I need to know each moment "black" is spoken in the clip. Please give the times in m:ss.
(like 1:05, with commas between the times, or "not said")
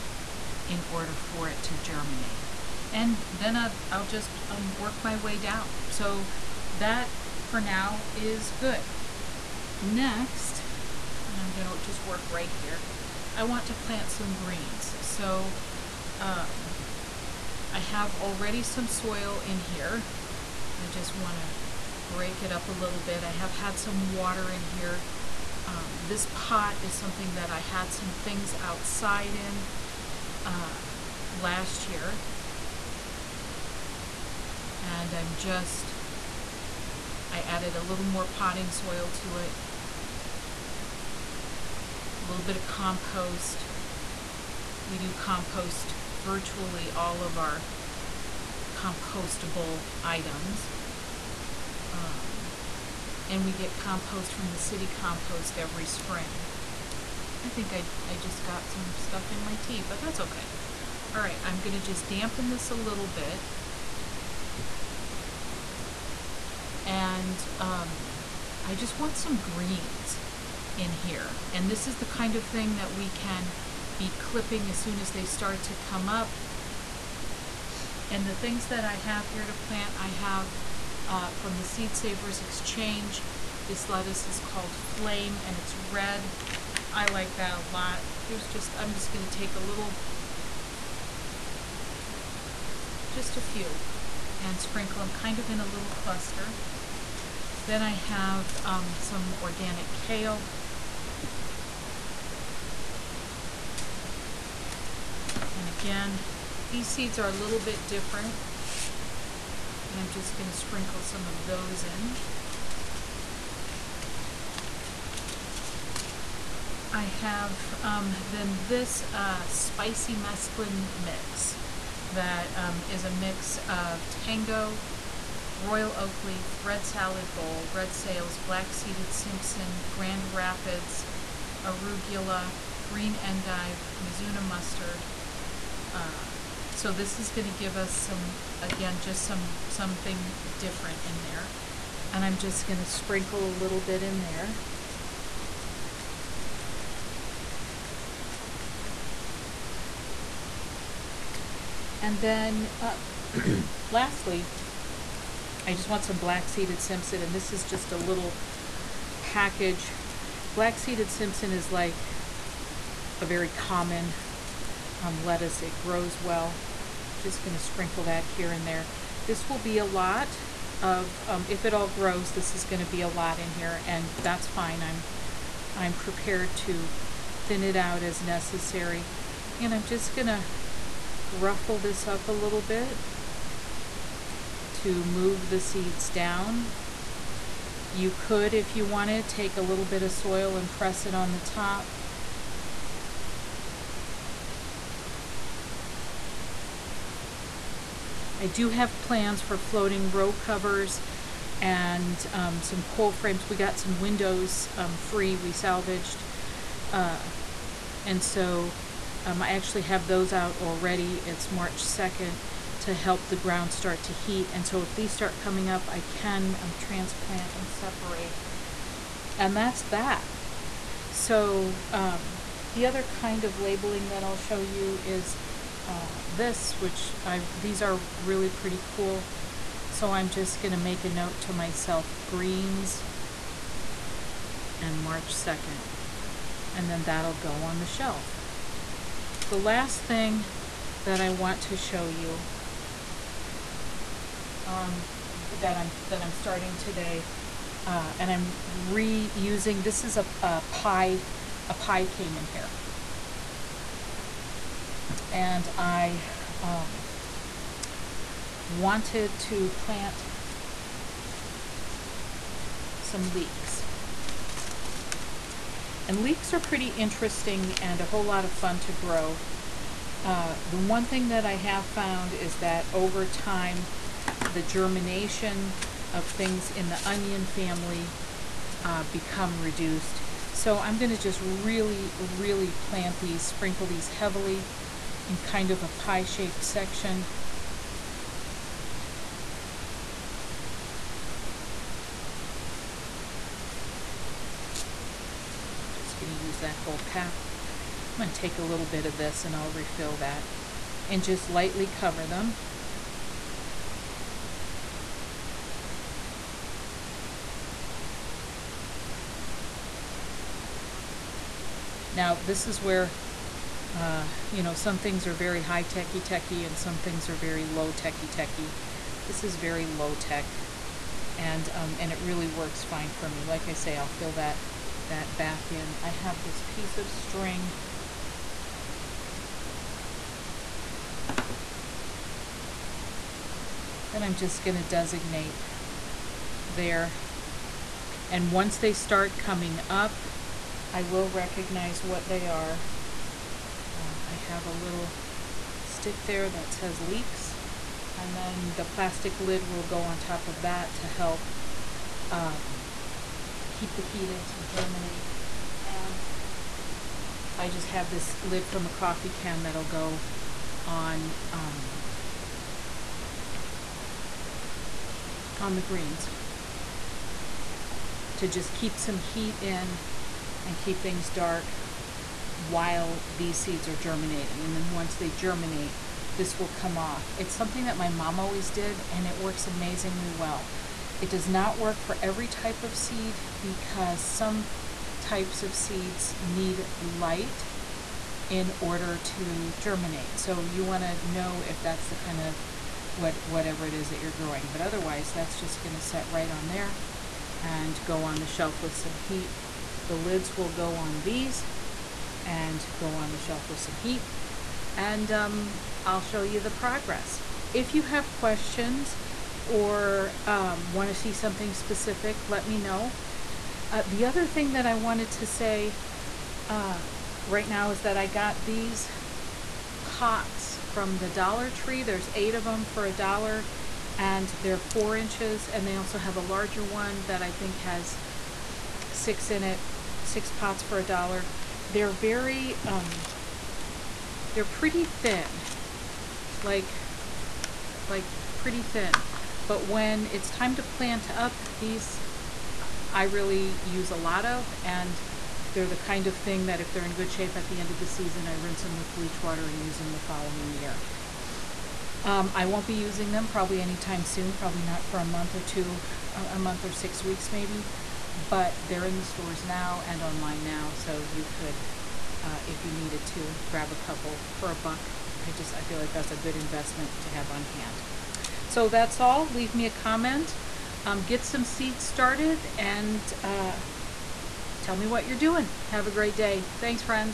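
2:08, 2:36, 2:40.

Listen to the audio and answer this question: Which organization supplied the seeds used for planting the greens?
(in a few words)
Seed Savers Exchange.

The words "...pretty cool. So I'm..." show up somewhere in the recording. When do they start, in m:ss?
3:48.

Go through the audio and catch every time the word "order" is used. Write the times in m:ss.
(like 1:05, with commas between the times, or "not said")
0:00, 6:28.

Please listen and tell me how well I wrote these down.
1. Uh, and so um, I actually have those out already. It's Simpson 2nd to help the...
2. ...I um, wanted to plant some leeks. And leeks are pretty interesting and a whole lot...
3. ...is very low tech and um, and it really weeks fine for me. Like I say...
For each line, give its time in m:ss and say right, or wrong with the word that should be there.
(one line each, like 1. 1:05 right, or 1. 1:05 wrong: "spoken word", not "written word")
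1. 3:26 wrong: "March", not "Simpson"
2. 4:15 right
3. 5:19 wrong: "works", not "weeks".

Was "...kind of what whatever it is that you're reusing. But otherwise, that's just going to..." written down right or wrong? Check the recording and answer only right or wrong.
wrong.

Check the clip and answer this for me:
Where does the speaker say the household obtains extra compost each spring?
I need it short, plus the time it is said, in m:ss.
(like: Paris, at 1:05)
the city compost, at 0:54.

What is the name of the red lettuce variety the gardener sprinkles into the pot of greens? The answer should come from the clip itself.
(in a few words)
Flame.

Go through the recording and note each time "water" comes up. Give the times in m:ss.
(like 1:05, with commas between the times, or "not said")
0:24, 7:29.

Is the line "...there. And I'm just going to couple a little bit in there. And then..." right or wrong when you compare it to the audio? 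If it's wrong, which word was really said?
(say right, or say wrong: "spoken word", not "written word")
wrong: "sprinkle", not "couple".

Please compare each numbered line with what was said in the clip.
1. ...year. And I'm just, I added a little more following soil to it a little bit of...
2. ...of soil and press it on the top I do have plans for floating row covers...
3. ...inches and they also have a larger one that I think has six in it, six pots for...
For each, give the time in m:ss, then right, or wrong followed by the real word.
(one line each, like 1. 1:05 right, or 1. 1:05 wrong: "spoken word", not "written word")
1. 0:31 wrong: "potting", not "following"
2. 3:10 right
3. 7:05 right.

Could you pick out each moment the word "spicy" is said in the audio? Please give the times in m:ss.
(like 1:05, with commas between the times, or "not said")
1:59.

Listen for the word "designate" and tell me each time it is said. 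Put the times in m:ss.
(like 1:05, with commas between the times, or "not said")
5:34.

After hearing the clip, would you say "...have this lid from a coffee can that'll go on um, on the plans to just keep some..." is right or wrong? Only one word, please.
wrong.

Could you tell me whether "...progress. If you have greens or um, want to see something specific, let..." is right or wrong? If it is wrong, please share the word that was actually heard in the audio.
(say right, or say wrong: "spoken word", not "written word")
wrong: "questions", not "greens".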